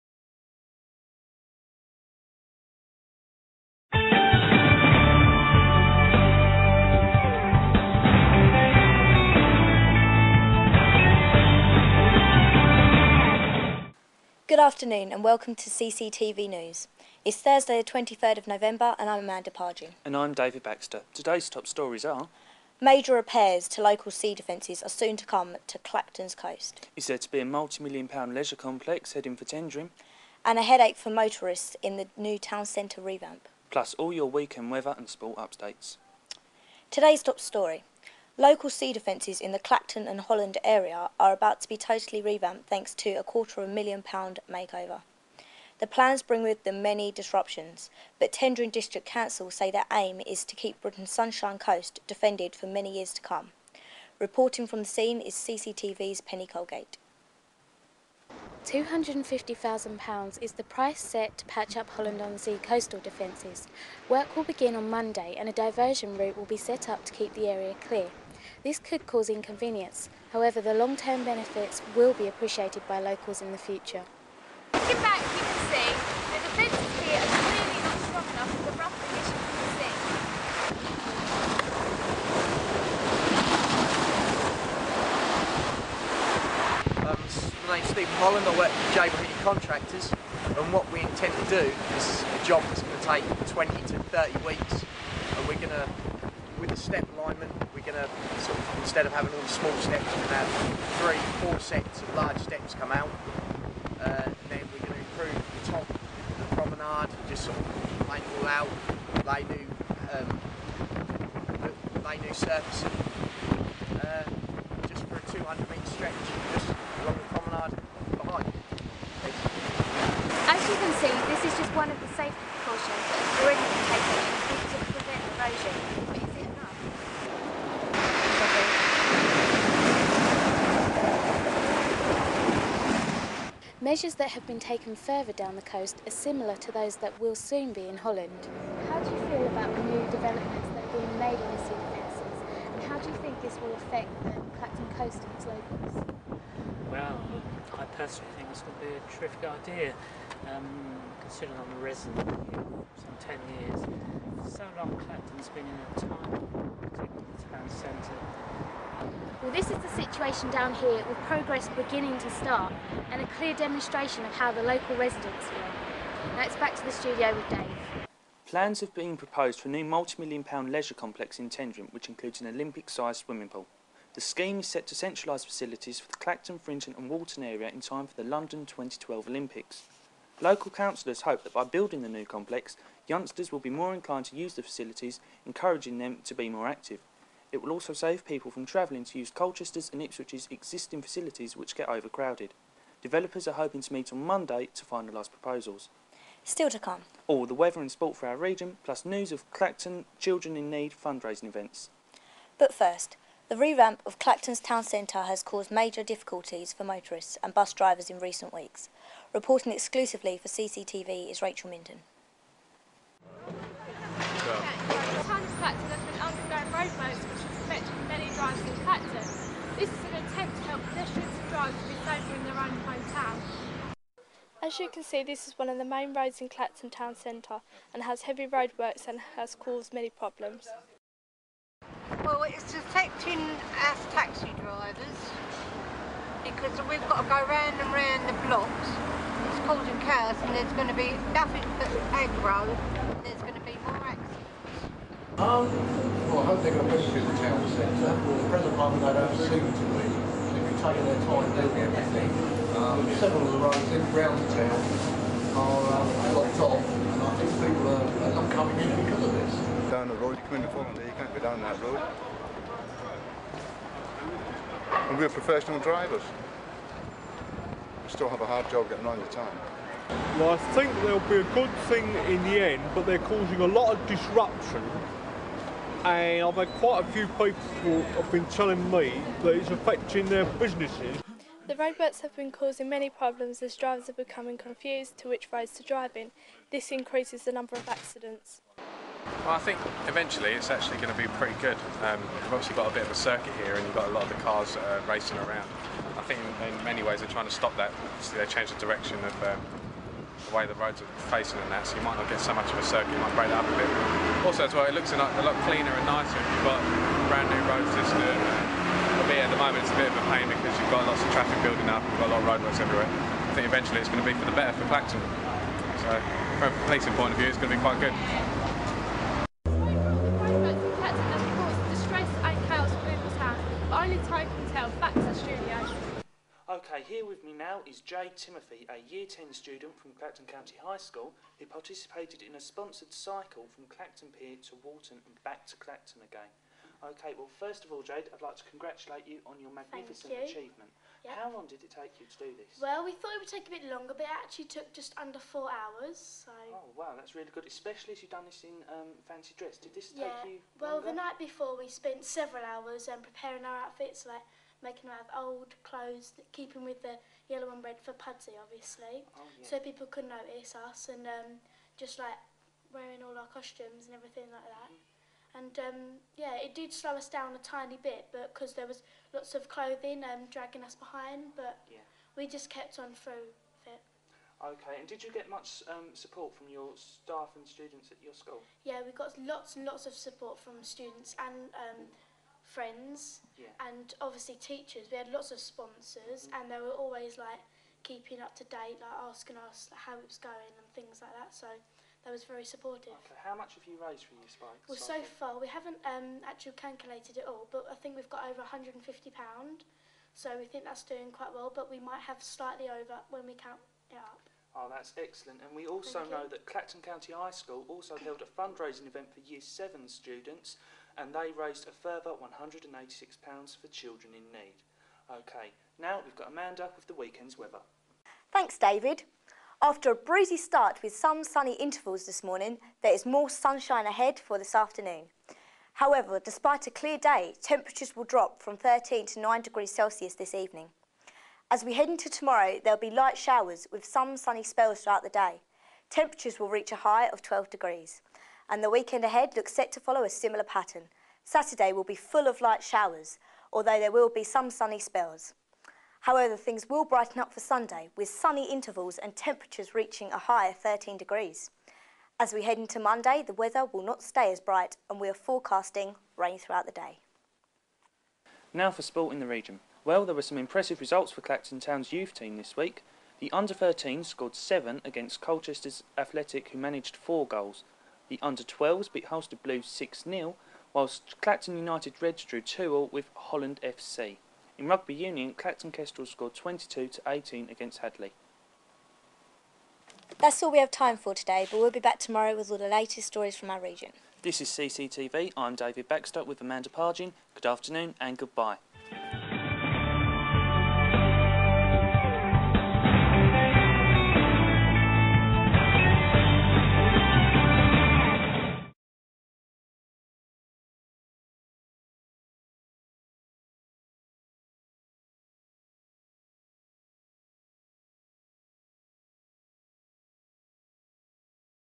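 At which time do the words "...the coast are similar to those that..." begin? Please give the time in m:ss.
2:15.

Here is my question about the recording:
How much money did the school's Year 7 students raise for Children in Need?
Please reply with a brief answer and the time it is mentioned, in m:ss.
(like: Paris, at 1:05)
£186, at 6:52.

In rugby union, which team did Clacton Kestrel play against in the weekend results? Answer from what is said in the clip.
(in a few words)
Hadley.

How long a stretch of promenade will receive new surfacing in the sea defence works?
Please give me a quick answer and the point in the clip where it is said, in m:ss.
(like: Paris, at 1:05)
200 metres, at 1:55.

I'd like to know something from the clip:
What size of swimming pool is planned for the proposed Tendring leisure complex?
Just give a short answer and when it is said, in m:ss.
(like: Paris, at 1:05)
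Olympic-sized, at 2:52.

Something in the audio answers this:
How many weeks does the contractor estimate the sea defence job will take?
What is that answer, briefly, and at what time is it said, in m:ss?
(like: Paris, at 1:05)
20 to 30 weeks, at 1:33.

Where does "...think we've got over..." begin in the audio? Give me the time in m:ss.
6:37.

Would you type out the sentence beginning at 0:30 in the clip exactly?
And a headache for motorists in the new town centre revamp.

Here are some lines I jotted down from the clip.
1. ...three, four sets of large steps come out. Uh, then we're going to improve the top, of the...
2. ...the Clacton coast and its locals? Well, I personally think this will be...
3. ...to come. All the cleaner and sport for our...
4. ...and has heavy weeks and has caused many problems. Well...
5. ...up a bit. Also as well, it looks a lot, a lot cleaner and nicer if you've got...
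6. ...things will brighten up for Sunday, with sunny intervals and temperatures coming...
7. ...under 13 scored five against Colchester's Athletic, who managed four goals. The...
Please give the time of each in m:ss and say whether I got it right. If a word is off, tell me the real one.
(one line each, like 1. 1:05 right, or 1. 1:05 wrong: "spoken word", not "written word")
1. 1:40 right
2. 2:24 right
3. 3:16 wrong: "weather", not "cleaner"
4. 3:47 wrong: "roadworks", not "weeks"
5. 5:03 right
6. 7:26 wrong: "reaching", not "coming"
7. 7:43 wrong: "seven", not "five".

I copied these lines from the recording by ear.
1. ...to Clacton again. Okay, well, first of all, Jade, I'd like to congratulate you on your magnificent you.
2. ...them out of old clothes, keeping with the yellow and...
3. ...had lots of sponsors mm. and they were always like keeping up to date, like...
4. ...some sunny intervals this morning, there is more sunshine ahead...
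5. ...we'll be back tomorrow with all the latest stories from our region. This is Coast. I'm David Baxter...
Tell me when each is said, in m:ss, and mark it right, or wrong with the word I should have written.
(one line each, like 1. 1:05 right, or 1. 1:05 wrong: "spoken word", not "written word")
1. 5:35 right
2. 5:55 right
3. 6:25 right
4. 7:01 right
5. 8:01 wrong: "CCTV", not "Coast".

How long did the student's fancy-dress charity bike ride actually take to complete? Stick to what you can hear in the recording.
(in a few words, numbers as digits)
just under four hours.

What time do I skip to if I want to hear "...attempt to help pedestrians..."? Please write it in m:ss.
3:40.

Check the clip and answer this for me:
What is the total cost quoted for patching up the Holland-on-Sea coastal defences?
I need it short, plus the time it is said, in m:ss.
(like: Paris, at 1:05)
£250,000, at 0:58.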